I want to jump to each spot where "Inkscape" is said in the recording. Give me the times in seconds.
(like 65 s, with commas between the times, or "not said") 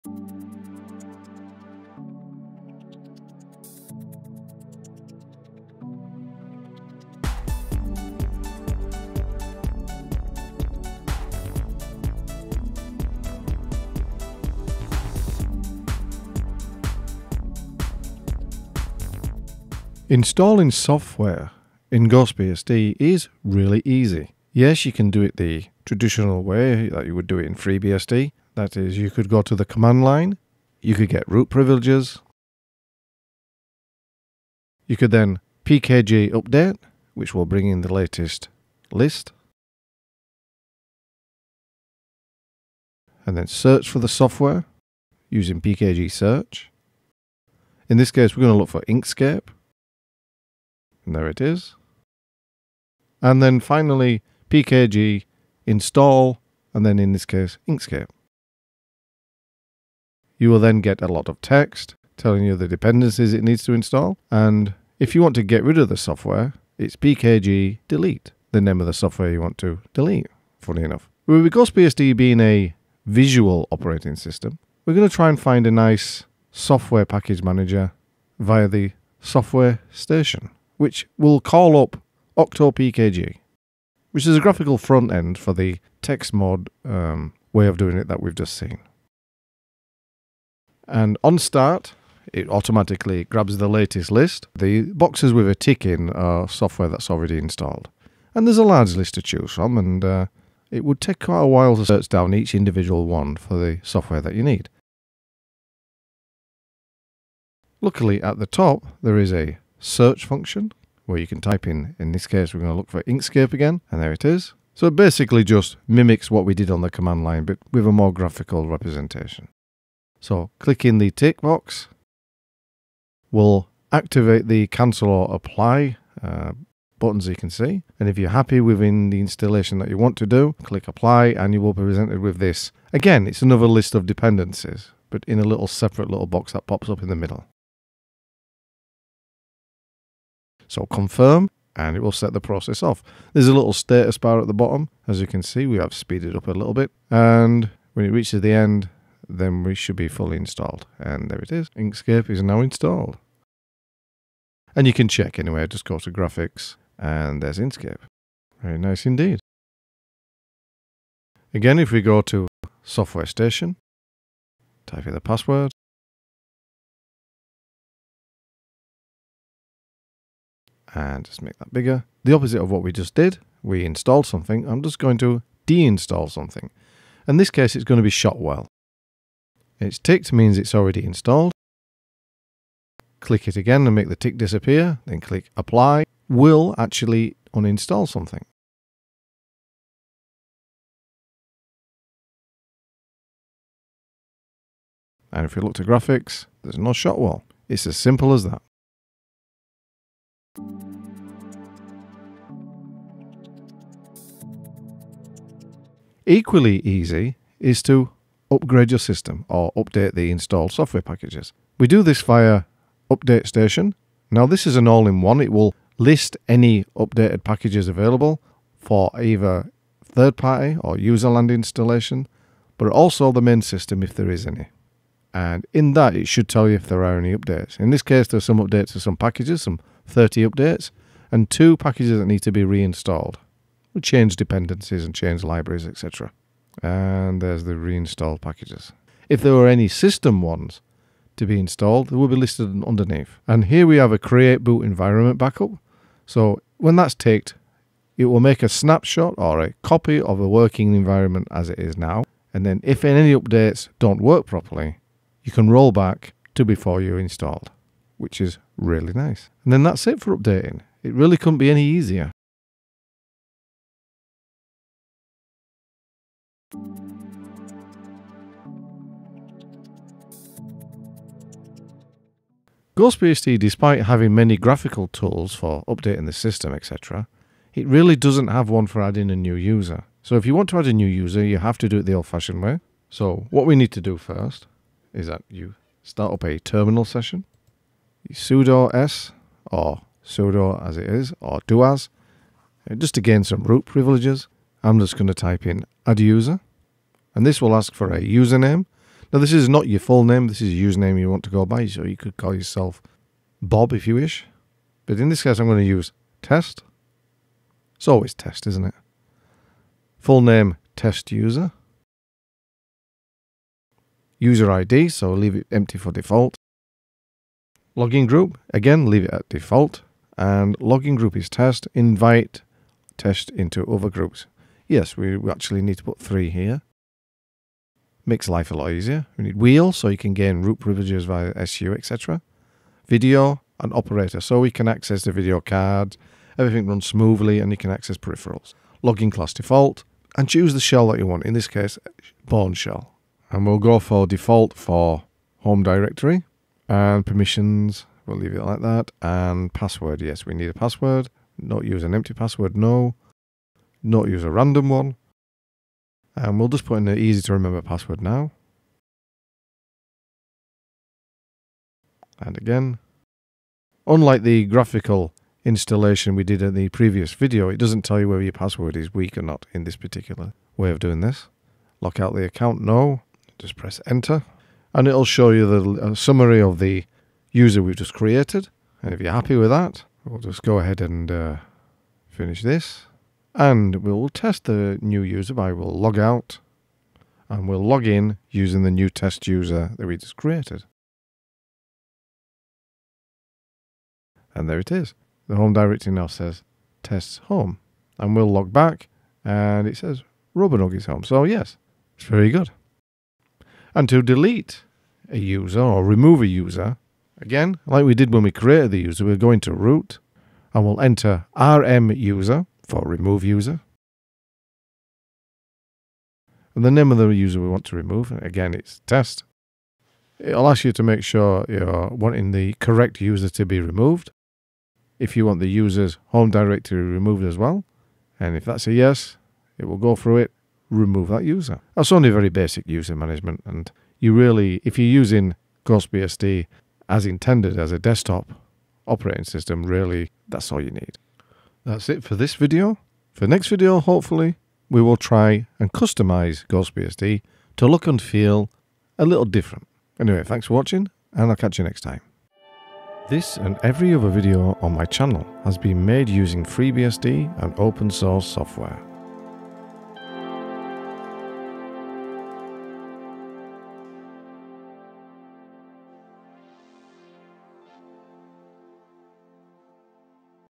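48 s, 57 s, 113 s, 151 s, 157 s.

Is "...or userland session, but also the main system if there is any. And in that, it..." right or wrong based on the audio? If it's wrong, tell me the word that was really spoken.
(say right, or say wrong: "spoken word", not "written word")
wrong: "installation", not "session".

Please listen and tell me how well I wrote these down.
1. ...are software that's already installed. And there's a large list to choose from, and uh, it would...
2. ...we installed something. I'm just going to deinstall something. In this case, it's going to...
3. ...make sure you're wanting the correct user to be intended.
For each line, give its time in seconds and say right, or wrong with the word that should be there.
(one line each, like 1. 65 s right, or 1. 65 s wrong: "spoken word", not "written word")
1. 96 s right
2. 173 s right
3. 421 s wrong: "removed", not "intended".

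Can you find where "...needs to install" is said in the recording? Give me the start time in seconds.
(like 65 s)
63 s.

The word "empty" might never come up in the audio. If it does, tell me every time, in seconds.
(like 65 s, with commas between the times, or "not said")
315 s, 352 s.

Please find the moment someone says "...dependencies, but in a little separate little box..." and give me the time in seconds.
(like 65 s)
134 s.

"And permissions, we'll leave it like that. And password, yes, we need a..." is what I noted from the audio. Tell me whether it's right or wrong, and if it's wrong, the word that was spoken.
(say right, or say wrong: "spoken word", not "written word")
right.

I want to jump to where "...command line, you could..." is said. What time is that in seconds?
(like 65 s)
29 s.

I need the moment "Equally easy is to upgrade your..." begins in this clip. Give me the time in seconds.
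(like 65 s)
206 s.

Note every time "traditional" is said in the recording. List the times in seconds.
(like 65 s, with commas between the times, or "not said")
25 s.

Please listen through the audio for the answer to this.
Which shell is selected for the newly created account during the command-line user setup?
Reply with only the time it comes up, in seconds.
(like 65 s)
342 s.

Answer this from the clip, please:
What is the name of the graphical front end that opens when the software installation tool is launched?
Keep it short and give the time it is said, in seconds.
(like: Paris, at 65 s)
OctoPKG, at 82 s.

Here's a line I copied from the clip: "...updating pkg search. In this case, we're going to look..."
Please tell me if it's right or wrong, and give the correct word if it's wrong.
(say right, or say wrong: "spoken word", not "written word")
wrong: "using", not "updating".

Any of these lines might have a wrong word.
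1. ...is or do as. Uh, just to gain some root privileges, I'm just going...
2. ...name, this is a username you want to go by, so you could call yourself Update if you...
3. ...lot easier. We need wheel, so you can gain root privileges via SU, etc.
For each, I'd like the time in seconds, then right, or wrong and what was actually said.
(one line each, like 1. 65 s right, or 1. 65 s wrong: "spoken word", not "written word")
1. 291 s right
2. 300 s wrong: "Bob", not "Update"
3. 328 s right.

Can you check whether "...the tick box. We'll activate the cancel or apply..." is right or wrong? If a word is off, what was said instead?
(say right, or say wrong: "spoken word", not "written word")
right.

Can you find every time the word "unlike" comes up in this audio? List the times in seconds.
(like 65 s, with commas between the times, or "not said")
364 s.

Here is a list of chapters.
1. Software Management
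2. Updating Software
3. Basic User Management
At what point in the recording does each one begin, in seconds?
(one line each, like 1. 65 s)
1. 15 s
2. 200 s
3. 268 s.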